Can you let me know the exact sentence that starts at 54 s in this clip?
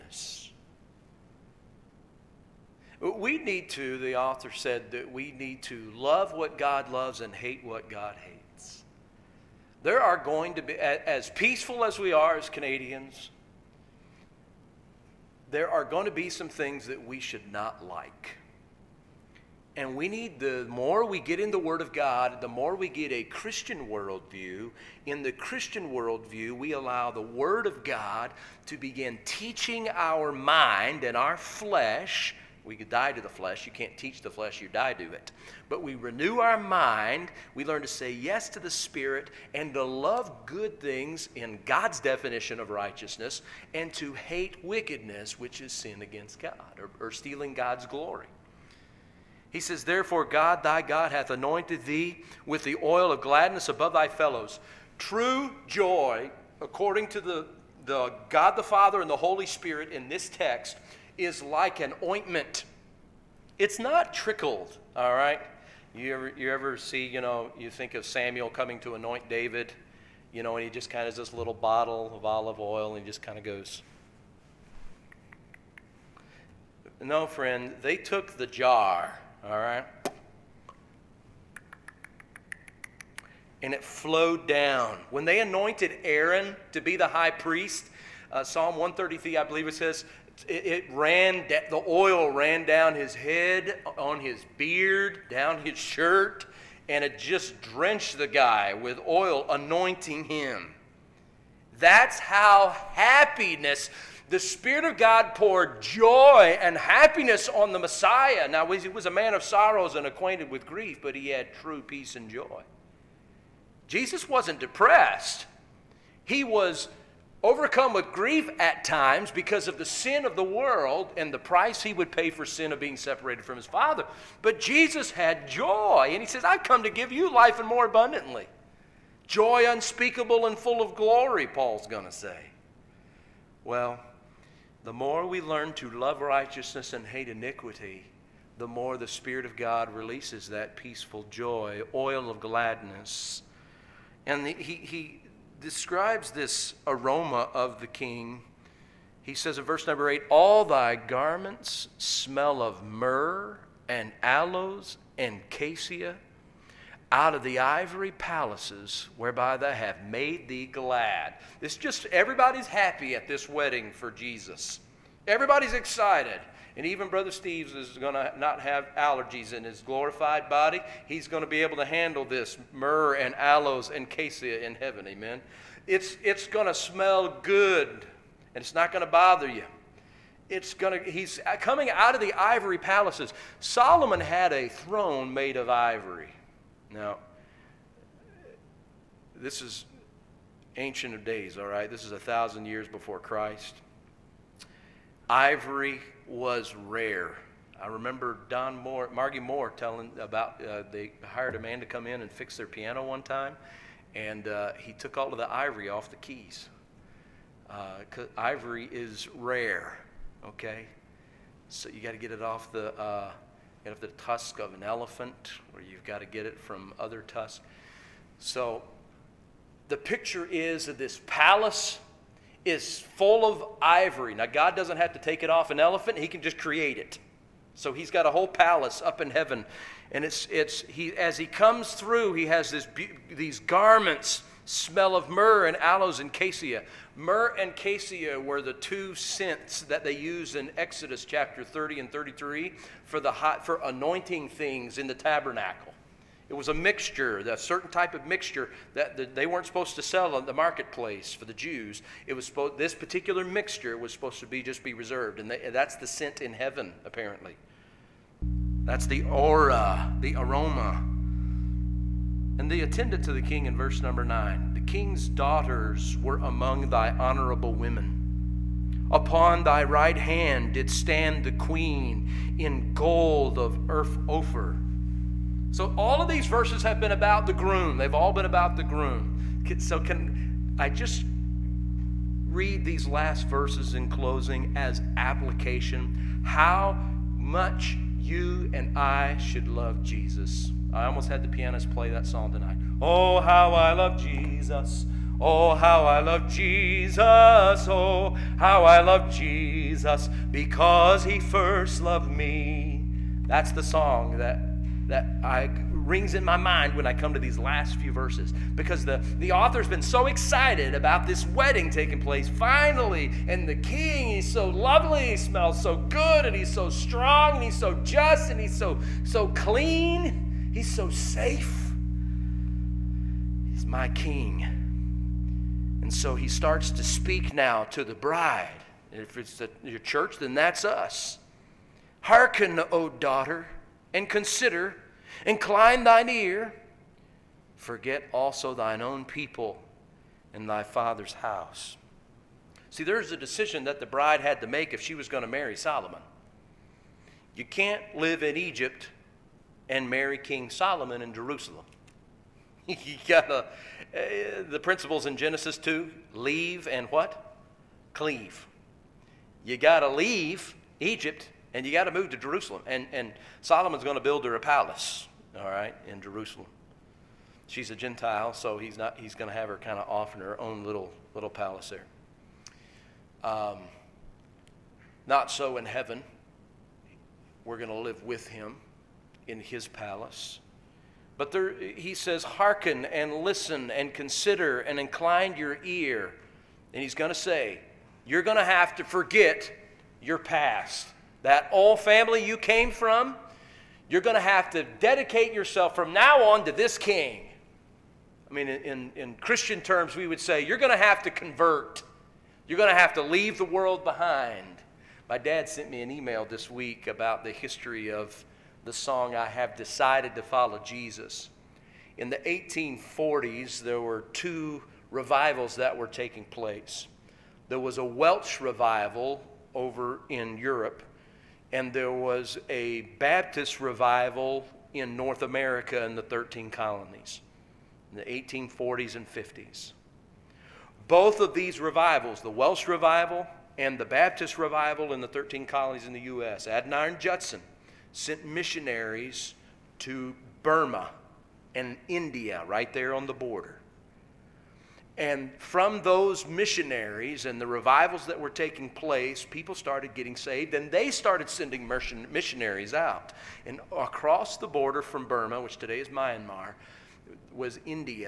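True joy, according to the, the God the Father and the Holy Spirit in this text, is like an ointment.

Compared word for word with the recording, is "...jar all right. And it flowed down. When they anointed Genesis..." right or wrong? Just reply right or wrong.
wrong.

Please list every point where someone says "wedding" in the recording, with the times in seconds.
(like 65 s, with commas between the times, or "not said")
163 s, 311 s.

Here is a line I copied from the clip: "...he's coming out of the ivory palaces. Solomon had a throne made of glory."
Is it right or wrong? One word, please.
wrong.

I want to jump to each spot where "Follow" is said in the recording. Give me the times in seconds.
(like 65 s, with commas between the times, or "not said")
410 s.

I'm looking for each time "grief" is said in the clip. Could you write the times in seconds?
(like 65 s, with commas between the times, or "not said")
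110 s, 118 s.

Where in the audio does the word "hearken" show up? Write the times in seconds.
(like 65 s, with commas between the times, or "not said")
332 s, 382 s.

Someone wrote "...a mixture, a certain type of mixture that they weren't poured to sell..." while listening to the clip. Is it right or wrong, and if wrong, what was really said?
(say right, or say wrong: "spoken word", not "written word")
wrong: "supposed", not "poured".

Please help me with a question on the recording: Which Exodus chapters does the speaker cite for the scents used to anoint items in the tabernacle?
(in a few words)
30 and 33.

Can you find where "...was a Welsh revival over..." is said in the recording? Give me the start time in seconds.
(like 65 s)
417 s.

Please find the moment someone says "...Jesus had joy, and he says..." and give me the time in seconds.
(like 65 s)
124 s.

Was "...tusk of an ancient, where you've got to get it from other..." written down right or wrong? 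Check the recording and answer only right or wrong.
wrong.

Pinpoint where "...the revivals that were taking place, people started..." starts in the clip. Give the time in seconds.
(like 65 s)
447 s.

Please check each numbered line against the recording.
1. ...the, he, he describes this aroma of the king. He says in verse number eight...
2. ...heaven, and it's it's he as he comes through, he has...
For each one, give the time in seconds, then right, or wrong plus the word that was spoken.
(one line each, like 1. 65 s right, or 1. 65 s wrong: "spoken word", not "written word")
1. 144 s right
2. 229 s right.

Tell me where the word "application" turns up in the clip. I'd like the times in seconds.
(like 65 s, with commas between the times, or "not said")
285 s.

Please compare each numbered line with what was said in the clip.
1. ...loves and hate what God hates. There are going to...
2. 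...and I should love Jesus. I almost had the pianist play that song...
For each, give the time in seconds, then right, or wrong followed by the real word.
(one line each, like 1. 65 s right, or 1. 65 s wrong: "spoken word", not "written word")
1. 6 s right
2. 288 s right.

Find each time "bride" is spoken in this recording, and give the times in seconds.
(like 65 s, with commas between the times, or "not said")
328 s, 344 s.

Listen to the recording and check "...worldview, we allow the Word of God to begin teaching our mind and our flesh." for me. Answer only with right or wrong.
right.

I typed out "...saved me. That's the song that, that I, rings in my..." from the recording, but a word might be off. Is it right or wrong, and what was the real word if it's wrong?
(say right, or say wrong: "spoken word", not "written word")
wrong: "loved", not "saved".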